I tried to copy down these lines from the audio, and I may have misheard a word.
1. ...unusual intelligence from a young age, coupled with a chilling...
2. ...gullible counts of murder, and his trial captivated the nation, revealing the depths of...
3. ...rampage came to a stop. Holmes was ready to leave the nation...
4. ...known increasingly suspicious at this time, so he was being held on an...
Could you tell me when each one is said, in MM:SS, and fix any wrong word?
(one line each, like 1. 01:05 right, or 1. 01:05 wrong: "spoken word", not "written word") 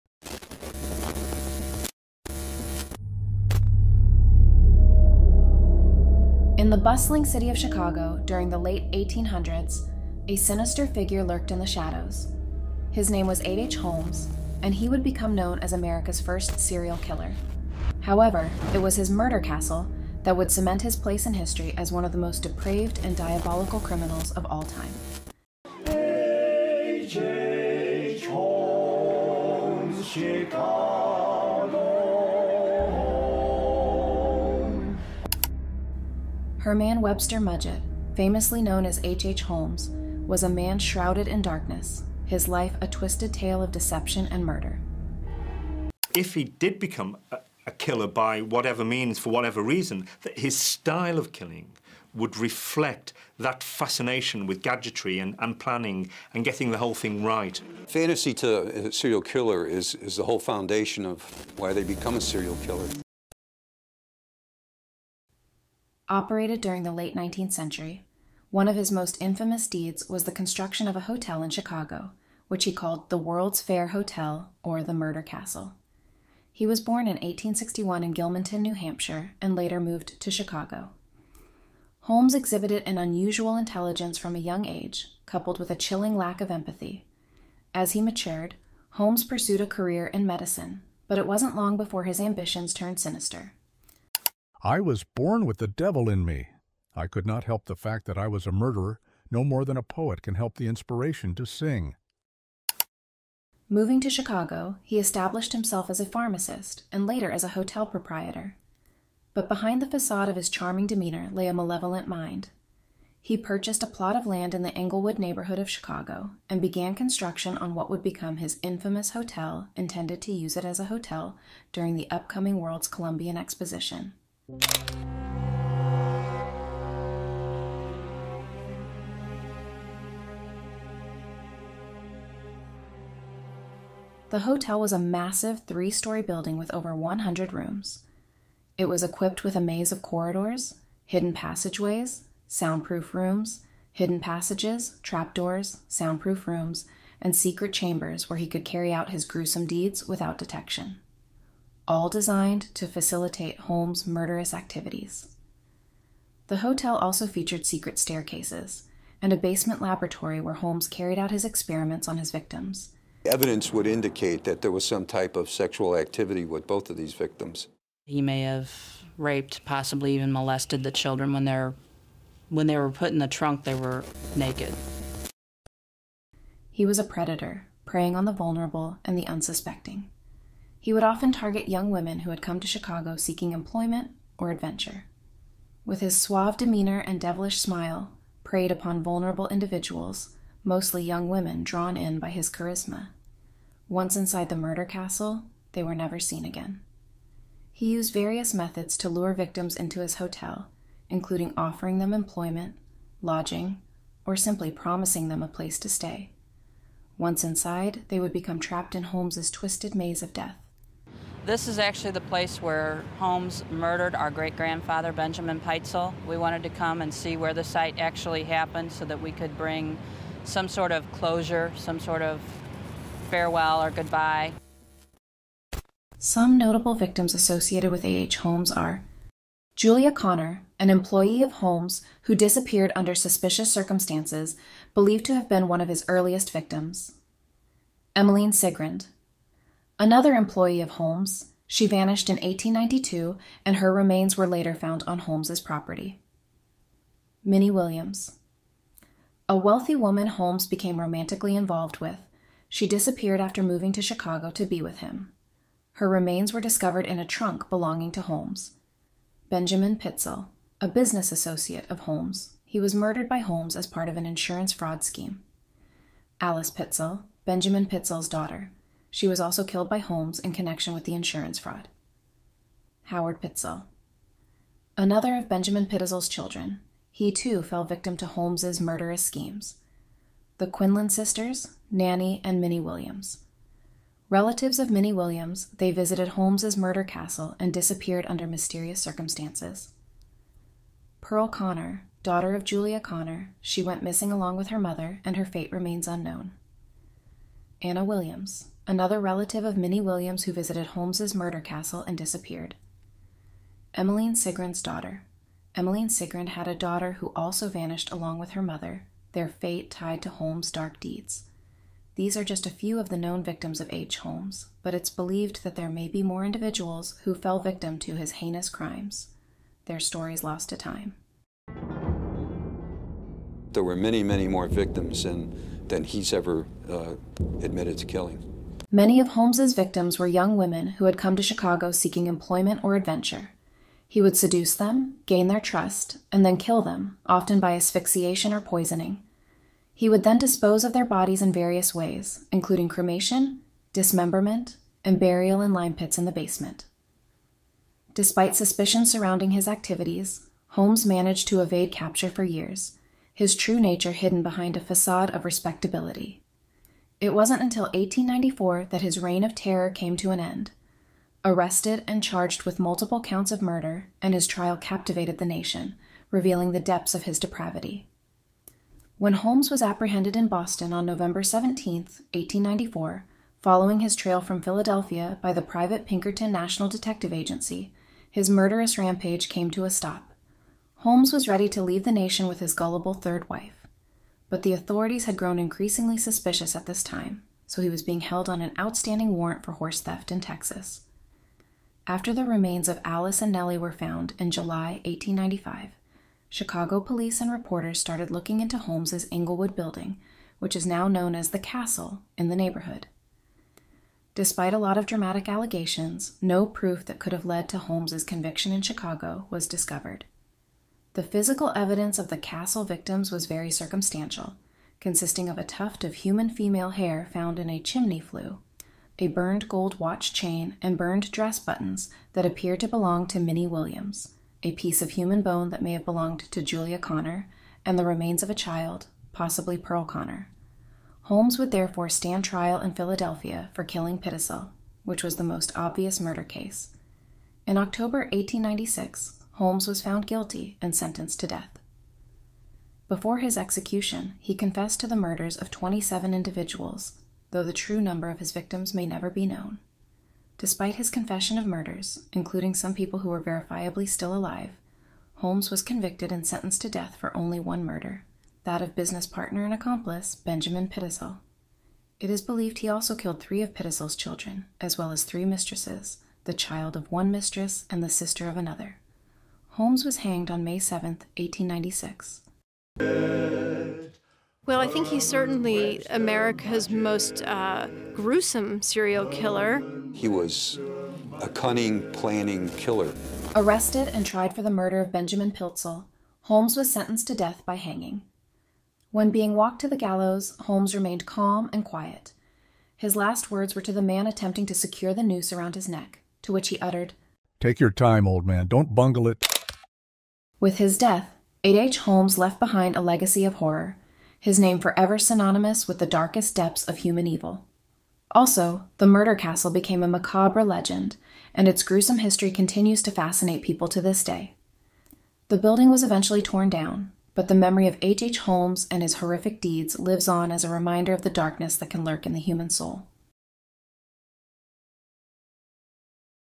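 1. 01:22 right
2. 06:02 wrong: "multiple", not "gullible"
3. 06:18 right
4. 06:25 wrong: "grown", not "known".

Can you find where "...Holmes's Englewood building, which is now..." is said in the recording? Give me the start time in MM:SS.
06:38.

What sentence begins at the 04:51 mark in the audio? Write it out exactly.
Pearl Connor, daughter of Julia Connor, she went missing along with her mother, and her fate remains unknown.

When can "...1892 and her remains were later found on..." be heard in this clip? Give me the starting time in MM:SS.
04:02.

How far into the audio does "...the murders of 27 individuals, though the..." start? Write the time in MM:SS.
07:25.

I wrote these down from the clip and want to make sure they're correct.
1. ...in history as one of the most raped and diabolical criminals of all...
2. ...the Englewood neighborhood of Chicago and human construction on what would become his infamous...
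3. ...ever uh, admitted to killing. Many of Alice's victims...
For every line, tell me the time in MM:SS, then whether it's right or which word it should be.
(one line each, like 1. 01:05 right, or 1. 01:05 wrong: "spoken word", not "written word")
1. 00:21 wrong: "depraved", not "raped"
2. 01:54 wrong: "began", not "human"
3. 05:26 wrong: "Holmes", not "Alice".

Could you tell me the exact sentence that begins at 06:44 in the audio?
Despite a lot of dramatic allegations, no proof that could have led to Holmes's conviction in Chicago was discovered.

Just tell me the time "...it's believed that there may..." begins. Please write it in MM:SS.
05:14.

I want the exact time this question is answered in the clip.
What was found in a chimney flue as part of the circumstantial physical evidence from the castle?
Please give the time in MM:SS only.
06:55.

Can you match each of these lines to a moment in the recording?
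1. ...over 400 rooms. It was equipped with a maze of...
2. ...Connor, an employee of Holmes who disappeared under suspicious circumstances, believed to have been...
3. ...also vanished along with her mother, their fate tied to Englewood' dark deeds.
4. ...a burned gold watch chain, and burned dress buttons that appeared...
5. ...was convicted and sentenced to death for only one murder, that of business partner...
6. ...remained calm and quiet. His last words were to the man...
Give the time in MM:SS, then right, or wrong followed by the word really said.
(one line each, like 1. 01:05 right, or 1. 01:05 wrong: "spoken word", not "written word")
1. 02:16 wrong: "100", not "400"
2. 03:50 right
3. 05:07 wrong: "Holmes", not "Englewood"
4. 06:59 right
5. 07:35 right
6. 08:10 right.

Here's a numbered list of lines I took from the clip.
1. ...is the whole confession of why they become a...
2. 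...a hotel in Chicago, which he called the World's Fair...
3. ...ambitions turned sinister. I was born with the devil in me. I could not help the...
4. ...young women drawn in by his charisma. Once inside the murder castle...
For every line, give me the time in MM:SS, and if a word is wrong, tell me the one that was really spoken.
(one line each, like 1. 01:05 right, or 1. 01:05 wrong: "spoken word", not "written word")
1. 00:59 wrong: "foundation", not "confession"
2. 01:10 right
3. 01:32 right
4. 03:11 right.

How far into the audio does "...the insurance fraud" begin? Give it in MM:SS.
04:31.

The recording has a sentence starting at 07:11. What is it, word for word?
Holmes would therefore stand trial in Philadelphia for killing Pitezel, which was the most obvious murder case.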